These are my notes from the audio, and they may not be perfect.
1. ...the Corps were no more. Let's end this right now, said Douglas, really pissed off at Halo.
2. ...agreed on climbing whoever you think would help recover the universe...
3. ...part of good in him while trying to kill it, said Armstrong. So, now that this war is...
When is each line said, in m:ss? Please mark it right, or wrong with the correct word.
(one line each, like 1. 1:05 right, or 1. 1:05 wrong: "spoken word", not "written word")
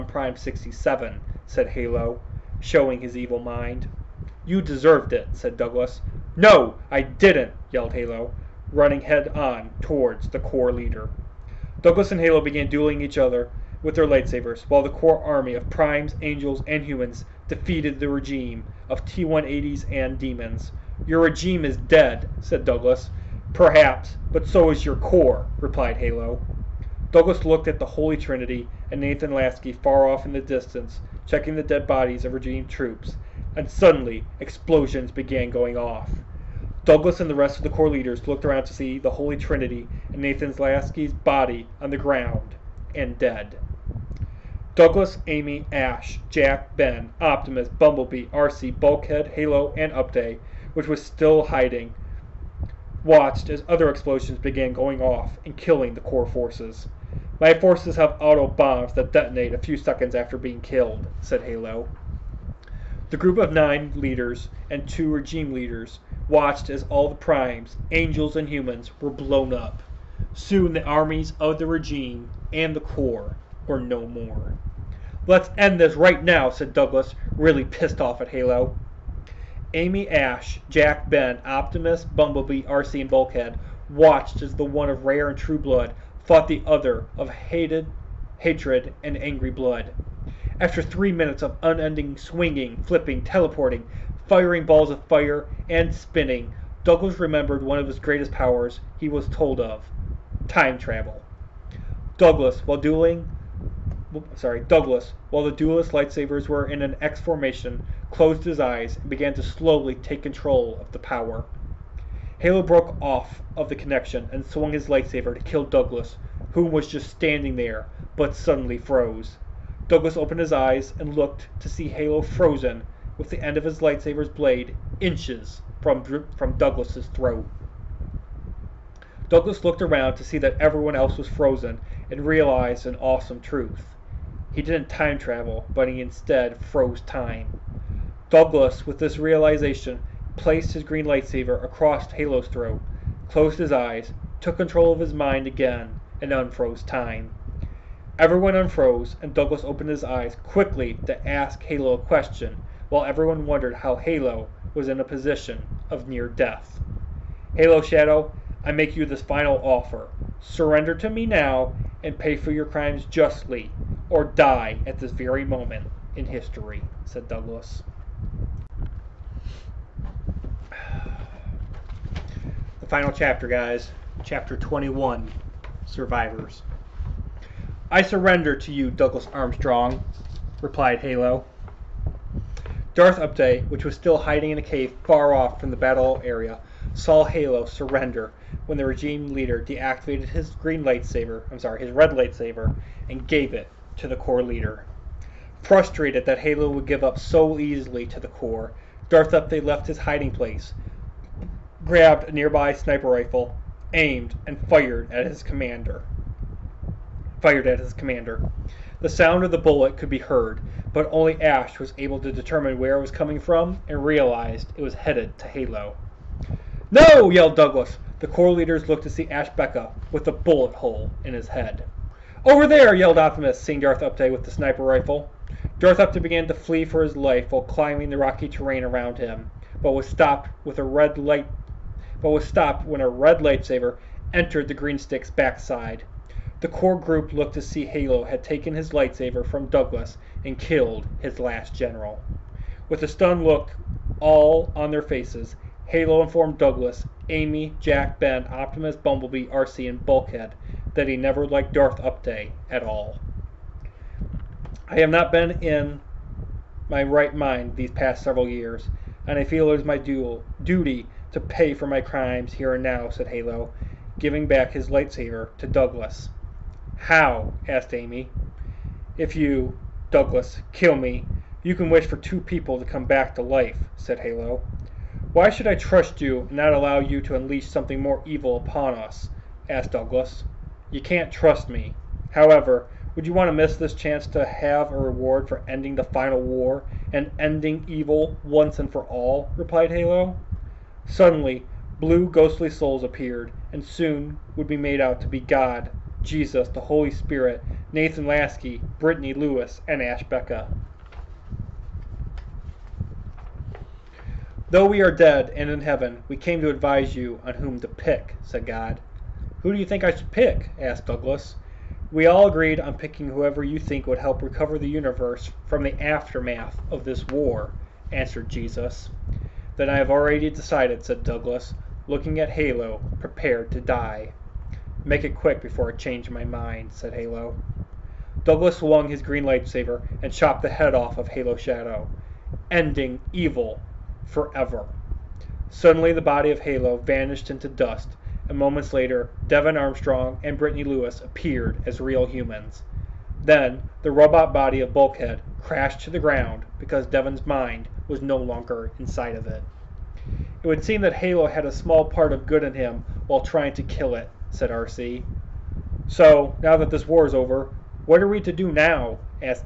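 1. 1:12 right
2. 5:12 wrong: "picking", not "climbing"
3. 5:52 wrong: "Arcee", not "Armstrong".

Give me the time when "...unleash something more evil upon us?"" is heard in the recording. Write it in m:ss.
4:37.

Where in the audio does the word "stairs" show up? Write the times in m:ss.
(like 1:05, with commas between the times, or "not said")
not said.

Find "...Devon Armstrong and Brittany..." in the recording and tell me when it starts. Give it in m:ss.
5:39.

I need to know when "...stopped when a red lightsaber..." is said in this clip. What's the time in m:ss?
3:52.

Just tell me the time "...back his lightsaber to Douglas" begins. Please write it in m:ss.
4:24.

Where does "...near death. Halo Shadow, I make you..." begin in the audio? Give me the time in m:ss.
2:36.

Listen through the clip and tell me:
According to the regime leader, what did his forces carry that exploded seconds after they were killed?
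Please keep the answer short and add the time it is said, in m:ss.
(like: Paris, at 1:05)
auto bombs, at 0:58.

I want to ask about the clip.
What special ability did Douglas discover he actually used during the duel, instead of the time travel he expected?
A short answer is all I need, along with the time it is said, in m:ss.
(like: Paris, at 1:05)
froze time, at 2:16.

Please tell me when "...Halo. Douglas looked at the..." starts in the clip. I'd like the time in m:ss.
0:25.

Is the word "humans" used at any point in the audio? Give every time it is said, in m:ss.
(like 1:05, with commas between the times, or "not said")
0:16, 1:08, 5:42.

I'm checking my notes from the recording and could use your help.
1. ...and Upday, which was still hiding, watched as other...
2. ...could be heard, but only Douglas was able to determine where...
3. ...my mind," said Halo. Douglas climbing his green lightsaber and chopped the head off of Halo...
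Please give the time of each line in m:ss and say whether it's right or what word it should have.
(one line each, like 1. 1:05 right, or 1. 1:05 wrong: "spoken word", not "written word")
1. 0:49 right
2. 3:29 wrong: "Ash", not "Douglas"
3. 5:26 wrong: "swung", not "climbing".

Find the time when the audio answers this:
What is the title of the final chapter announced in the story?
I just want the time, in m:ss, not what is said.
2:55.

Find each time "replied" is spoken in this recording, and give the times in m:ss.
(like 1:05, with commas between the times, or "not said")
0:25, 3:00, 4:49.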